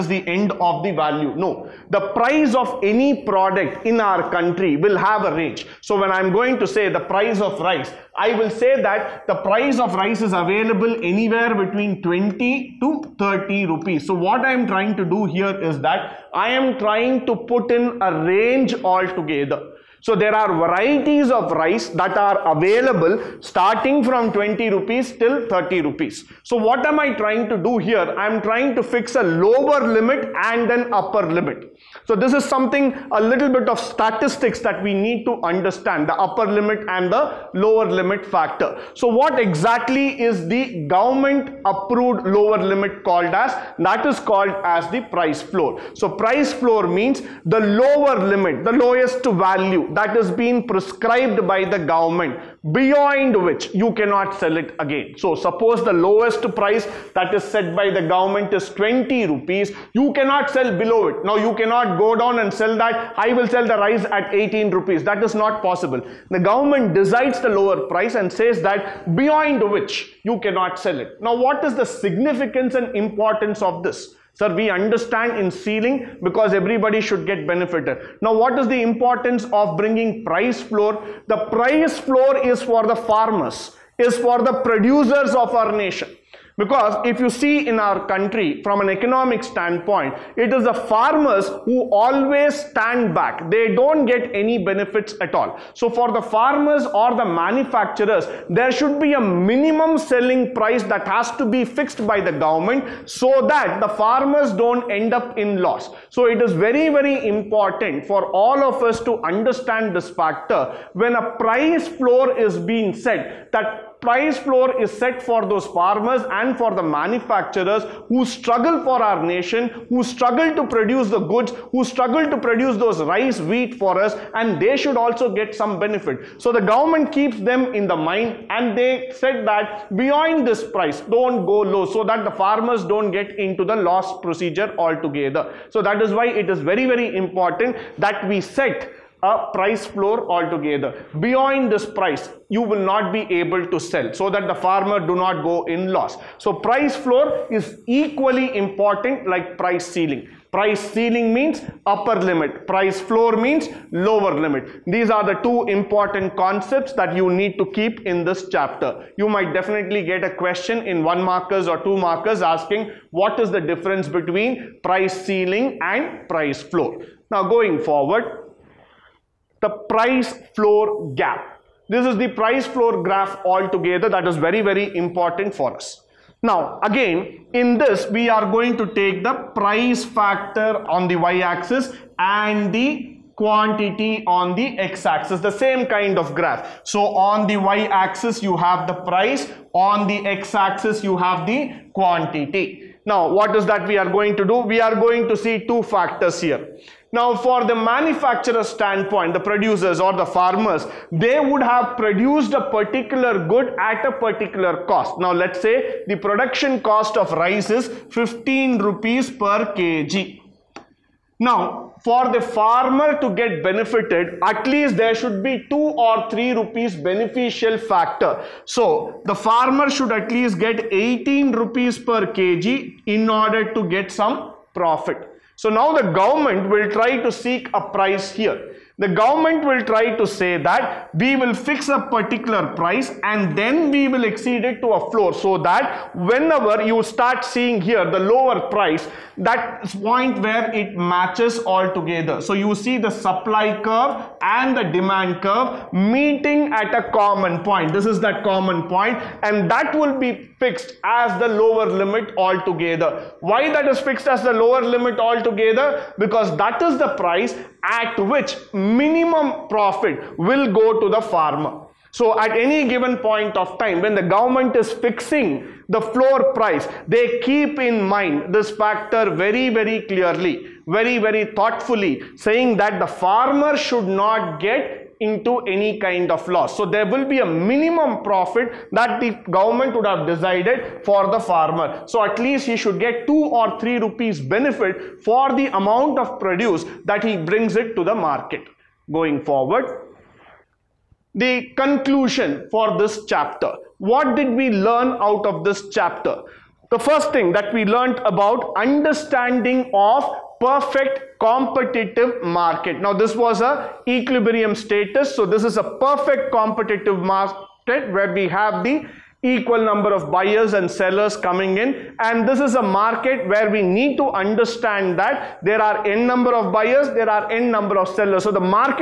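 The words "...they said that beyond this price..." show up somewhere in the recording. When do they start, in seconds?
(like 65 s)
128 s.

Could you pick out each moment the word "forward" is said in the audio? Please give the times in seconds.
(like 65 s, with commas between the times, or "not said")
167 s, 289 s.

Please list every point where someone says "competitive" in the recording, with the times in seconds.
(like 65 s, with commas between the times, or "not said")
301 s, 306 s.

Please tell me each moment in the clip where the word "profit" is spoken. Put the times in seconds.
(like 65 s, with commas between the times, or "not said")
224 s, 259 s, 278 s.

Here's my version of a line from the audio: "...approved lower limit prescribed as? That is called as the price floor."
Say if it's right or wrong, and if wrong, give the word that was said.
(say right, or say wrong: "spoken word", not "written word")
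wrong: "called", not "prescribed".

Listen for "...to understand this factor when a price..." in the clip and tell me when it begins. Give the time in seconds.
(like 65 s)
109 s.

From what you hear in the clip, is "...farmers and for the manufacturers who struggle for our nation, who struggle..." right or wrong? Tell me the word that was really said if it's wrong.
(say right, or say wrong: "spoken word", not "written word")
right.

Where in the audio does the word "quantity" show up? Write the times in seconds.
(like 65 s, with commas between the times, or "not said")
183 s, 191 s.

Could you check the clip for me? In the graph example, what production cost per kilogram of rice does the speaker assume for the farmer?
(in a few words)
15 rupees.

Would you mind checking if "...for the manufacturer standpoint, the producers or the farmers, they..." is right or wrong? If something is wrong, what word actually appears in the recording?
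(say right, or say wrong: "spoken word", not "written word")
right.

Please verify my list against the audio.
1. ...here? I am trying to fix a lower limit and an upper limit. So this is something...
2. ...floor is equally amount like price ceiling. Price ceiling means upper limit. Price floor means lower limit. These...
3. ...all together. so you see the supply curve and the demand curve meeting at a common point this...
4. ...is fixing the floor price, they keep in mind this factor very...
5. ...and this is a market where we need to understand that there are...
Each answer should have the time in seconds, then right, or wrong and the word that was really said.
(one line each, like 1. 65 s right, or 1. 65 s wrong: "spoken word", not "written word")
1. 27 s right
2. 146 s wrong: "important", not "amount"
3. 241 s right
4. 264 s right
5. 312 s right.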